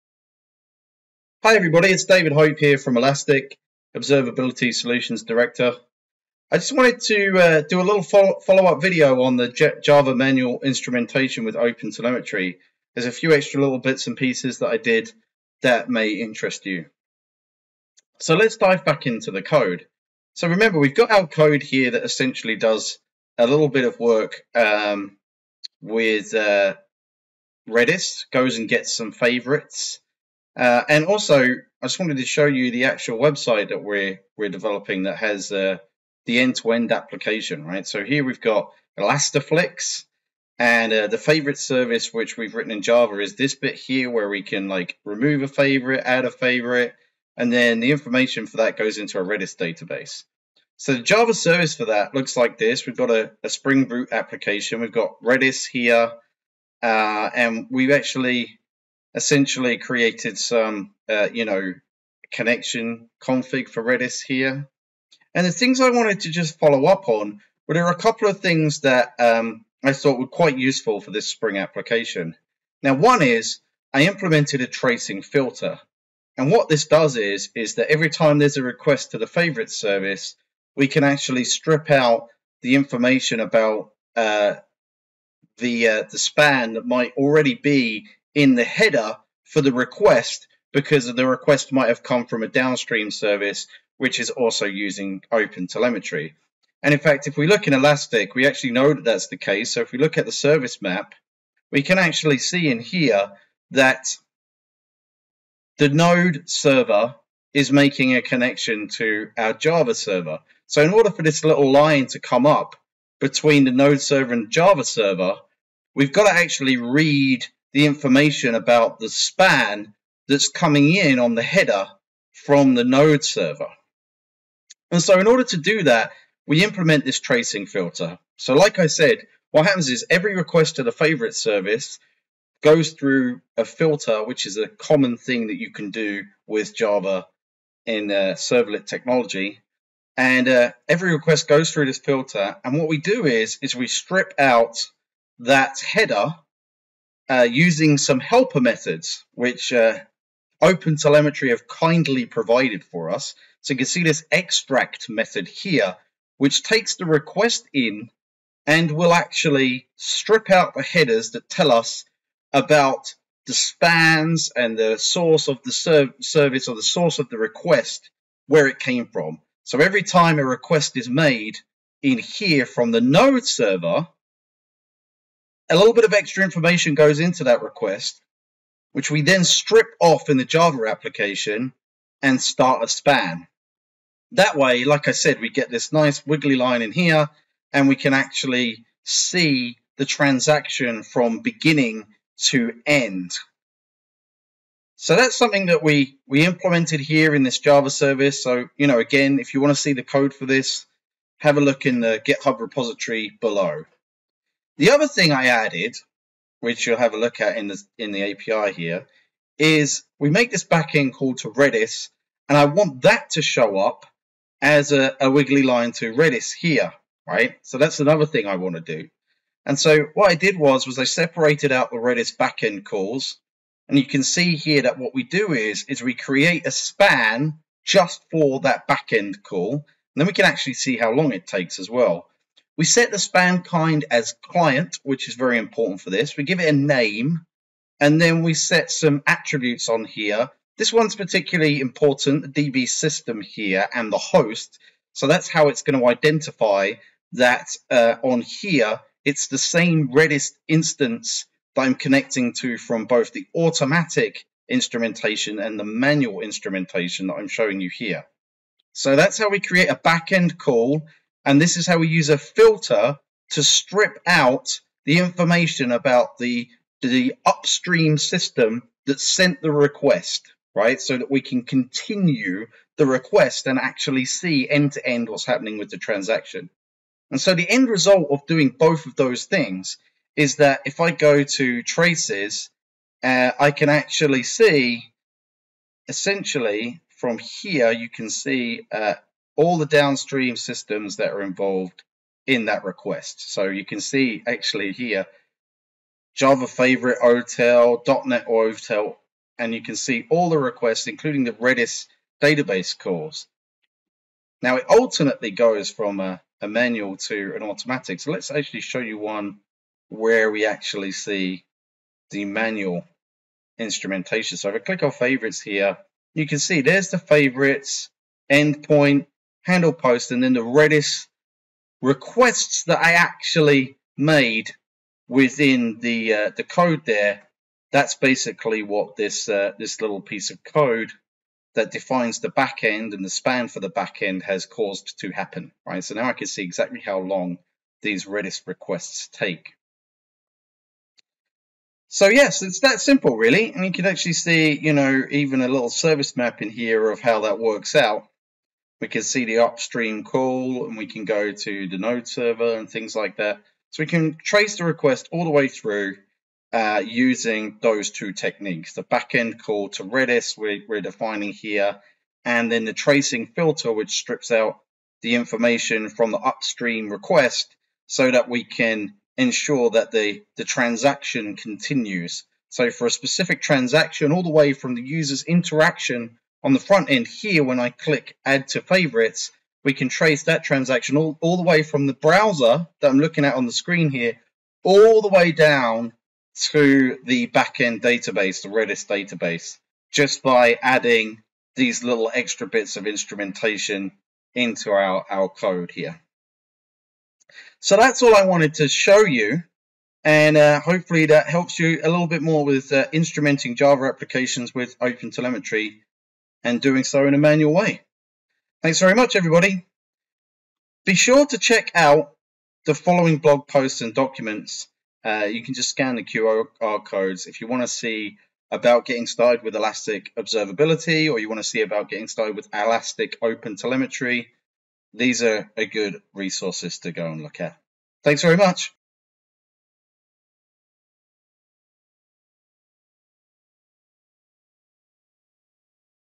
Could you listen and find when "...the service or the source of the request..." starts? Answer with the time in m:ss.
2:45.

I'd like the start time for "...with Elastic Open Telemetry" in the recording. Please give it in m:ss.
7:02.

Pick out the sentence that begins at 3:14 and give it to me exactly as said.
So that's something that we, we implemented here in this Java service.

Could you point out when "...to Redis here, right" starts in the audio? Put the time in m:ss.
3:35.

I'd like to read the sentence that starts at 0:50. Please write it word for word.
So the Java service for that looks like this.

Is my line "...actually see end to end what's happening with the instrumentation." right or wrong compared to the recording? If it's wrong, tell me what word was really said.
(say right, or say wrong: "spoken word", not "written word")
wrong: "transaction", not "instrumentation".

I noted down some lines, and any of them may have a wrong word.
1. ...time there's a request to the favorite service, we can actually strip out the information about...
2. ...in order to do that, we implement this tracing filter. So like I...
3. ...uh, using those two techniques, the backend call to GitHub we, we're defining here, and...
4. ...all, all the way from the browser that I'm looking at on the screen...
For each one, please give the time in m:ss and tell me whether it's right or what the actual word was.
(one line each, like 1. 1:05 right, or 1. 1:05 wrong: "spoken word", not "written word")
1. 1:18 right
2. 2:05 right
3. 5:56 wrong: "Redis", not "GitHub"
4. 6:21 right.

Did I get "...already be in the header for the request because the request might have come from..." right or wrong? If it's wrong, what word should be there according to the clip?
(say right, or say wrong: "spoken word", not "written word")
right.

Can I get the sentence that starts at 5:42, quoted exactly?
So yes, it's that simple really.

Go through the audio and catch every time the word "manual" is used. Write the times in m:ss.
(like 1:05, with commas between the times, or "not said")
0:10, 4:15, 5:06, 5:12, 6:47.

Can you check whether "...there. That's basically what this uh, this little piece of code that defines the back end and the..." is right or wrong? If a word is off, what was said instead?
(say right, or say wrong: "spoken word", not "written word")
right.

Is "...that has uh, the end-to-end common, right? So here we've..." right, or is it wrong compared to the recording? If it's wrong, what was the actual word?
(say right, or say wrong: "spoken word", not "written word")
wrong: "application", not "common".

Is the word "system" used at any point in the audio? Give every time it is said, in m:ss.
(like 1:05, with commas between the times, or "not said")
4:02, 4:28, 4:50.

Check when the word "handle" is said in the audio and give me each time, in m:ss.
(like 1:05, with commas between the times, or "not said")
5:19.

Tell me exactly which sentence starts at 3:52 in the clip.
We set the span kind as client, which is very important for this.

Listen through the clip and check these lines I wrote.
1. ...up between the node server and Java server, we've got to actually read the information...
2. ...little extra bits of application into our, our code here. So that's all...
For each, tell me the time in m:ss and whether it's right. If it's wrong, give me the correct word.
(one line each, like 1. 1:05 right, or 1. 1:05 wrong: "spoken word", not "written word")
1. 1:52 right
2. 6:32 wrong: "instrumentation", not "application".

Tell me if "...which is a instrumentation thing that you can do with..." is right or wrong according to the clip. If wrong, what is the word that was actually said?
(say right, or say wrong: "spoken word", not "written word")
wrong: "common", not "instrumentation".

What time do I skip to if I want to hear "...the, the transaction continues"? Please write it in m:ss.
6:10.